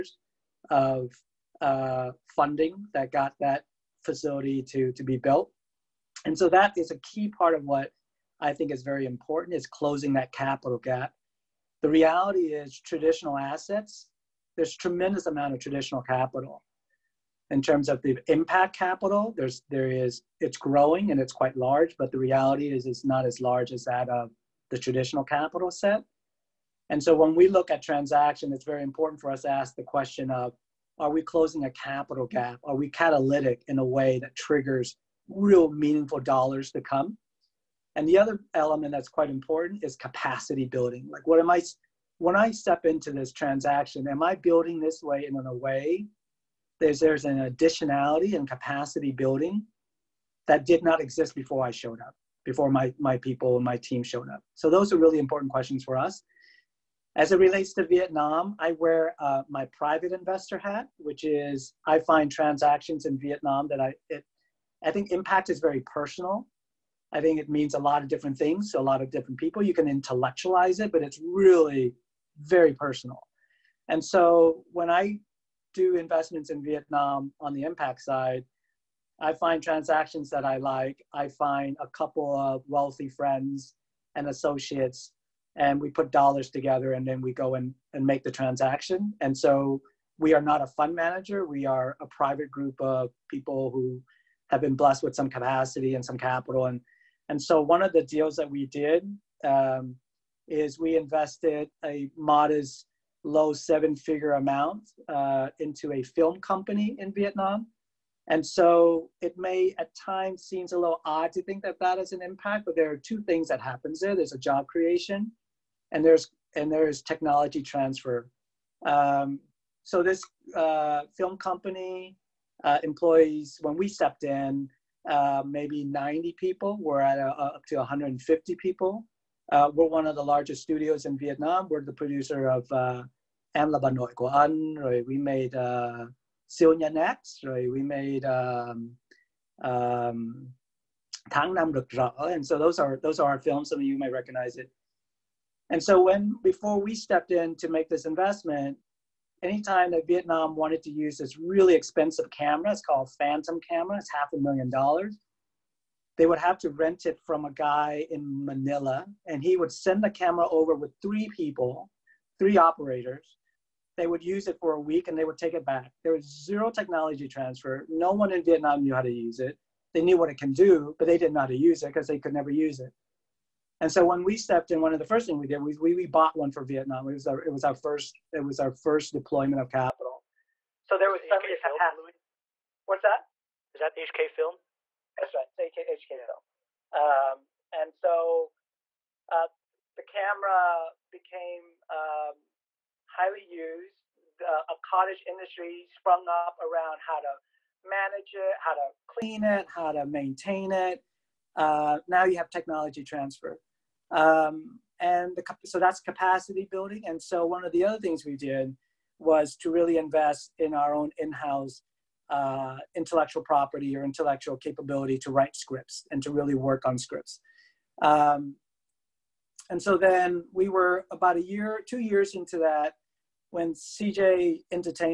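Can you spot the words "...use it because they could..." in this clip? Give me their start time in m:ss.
2:51.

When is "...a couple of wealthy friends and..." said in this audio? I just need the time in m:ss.
1:21.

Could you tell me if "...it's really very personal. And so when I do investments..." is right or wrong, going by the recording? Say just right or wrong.
right.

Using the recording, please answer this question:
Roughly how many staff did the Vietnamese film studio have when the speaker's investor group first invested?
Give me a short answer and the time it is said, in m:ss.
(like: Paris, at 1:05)
90, at 2:05.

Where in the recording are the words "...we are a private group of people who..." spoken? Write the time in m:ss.
1:31.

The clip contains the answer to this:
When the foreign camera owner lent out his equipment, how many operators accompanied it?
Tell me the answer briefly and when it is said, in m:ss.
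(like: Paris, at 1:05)
3, at 2:42.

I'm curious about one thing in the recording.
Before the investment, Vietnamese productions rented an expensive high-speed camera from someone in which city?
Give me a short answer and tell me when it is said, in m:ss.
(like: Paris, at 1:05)
Manila, at 2:38.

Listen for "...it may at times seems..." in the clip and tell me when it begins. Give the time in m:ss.
1:49.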